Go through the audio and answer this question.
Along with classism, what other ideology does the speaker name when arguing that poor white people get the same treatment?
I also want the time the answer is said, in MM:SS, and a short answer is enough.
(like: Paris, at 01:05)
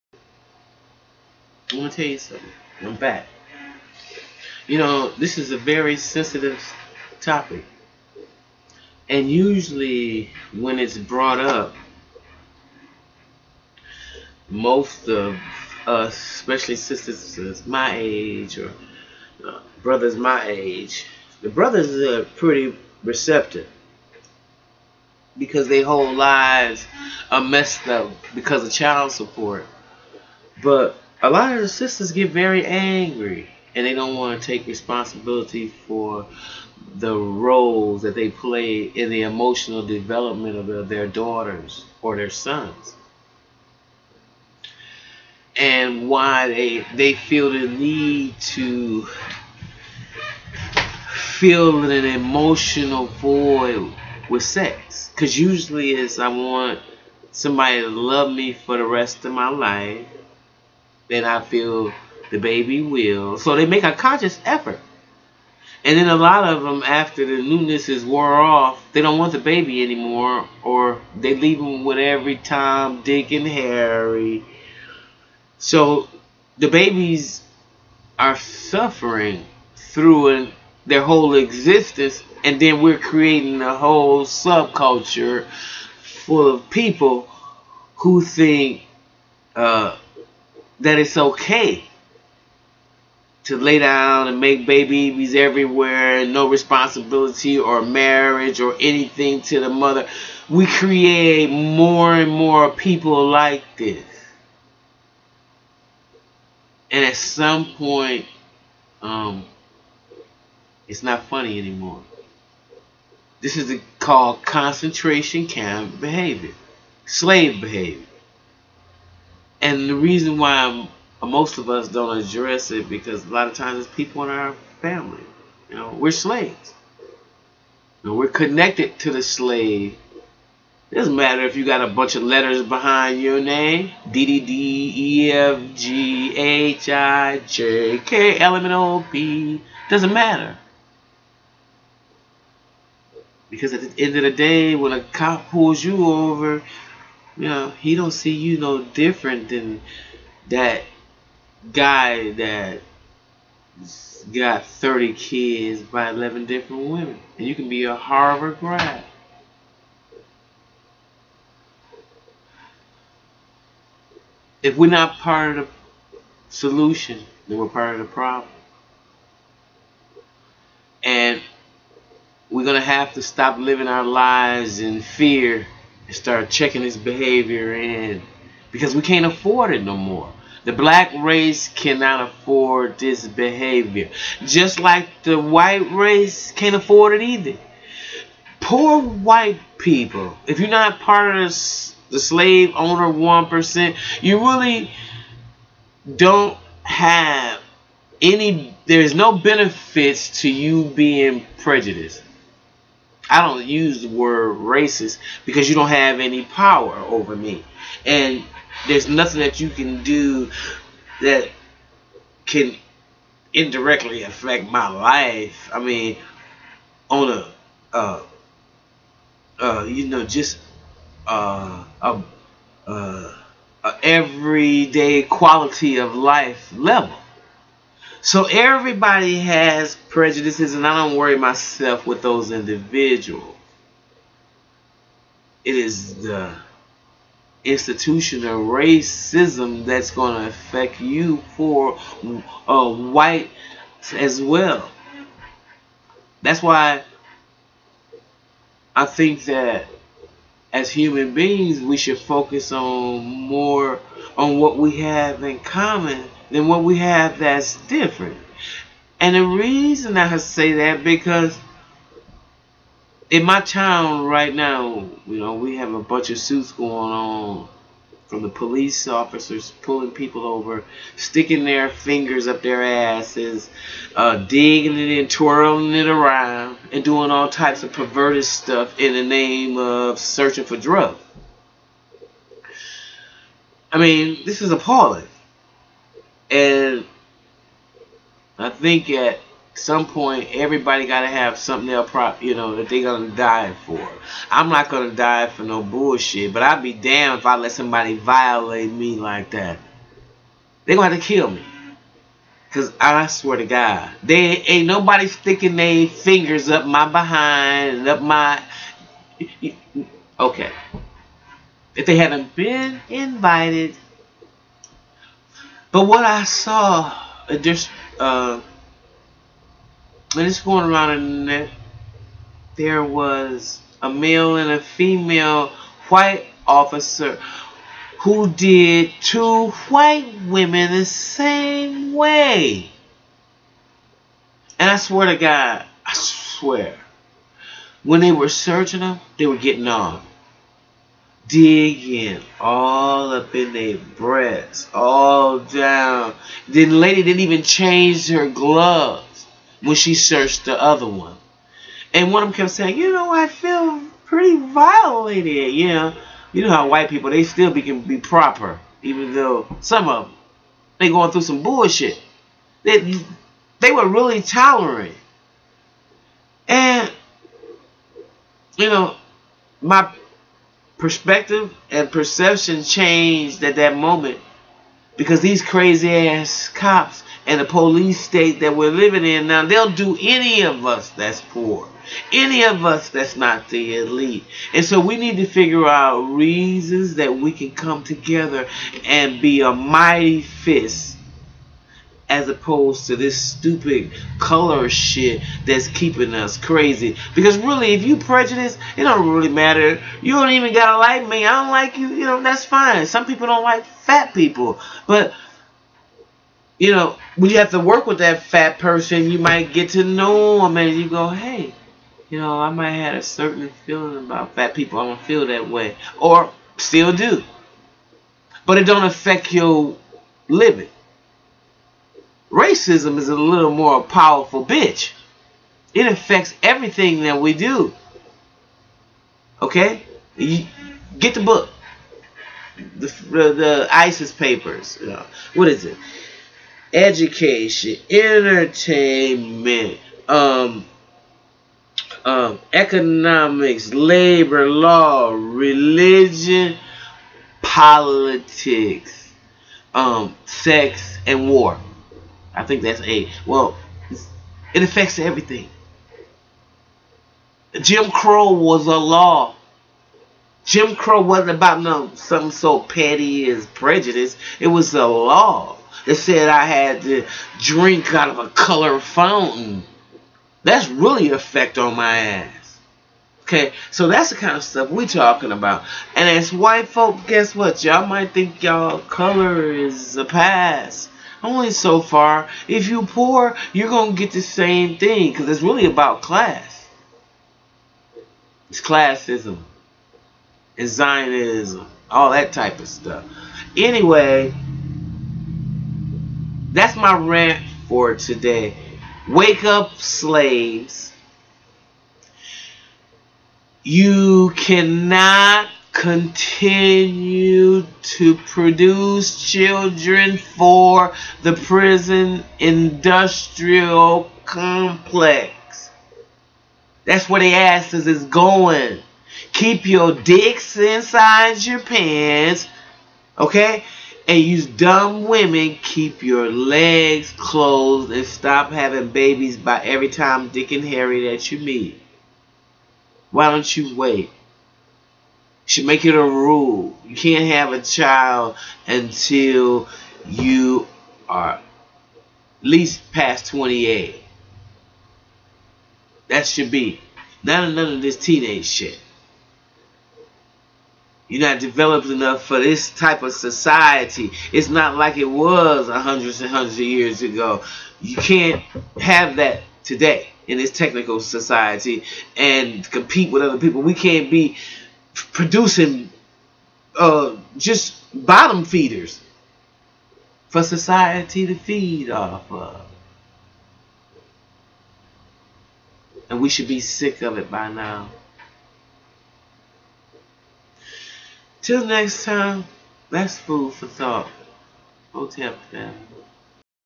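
Zionism, at 08:10.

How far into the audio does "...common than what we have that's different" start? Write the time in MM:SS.
04:15.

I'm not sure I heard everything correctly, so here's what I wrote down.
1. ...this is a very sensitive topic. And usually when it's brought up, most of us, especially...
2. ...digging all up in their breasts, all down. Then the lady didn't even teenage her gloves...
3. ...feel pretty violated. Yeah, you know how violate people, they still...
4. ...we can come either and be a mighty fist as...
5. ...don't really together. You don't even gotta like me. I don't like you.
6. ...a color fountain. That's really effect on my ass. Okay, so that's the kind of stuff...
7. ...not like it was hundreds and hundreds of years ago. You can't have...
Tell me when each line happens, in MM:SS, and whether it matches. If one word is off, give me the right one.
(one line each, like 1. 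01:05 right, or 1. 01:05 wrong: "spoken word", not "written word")
1. 00:05 right
2. 05:41 wrong: "change", not "teenage"
3. 05:53 wrong: "white", not "violate"
4. 06:27 wrong: "together", not "either"
5. 06:39 wrong: "matter", not "together"
6. 07:48 right
7. 09:14 right.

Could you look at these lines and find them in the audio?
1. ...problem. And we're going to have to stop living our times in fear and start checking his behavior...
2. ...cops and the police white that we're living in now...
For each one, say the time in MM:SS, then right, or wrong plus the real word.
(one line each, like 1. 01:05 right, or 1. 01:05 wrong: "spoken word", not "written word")
1. 02:48 wrong: "lives", not "times"
2. 06:16 wrong: "state", not "white".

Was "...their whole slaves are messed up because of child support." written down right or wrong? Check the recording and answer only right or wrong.
wrong.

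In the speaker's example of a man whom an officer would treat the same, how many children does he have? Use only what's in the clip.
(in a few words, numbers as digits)
30.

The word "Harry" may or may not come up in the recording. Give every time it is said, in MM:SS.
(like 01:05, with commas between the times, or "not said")
01:13, 08:50.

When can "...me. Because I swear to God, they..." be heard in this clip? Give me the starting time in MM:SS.
05:01.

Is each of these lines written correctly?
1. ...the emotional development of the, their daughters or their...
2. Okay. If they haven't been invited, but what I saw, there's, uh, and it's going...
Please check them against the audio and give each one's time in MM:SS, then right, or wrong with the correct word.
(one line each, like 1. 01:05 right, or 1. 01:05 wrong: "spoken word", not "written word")
1. 00:39 right
2. 05:10 right.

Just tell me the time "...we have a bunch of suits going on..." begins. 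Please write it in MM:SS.
04:25.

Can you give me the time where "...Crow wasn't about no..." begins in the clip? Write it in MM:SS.
07:40.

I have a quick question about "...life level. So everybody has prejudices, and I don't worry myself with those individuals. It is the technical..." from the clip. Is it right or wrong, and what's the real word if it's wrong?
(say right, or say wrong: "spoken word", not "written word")
wrong: "institutional", not "technical".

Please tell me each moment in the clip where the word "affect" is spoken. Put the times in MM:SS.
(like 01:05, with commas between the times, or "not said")
03:34, 04:00, 06:59, 07:06, 07:34.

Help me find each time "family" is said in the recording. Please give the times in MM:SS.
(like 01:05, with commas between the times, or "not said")
02:04, 09:45.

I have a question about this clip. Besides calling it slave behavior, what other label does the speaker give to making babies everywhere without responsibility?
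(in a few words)
concentration camp behavior.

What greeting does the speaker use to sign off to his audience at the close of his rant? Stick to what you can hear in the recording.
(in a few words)
Hotep.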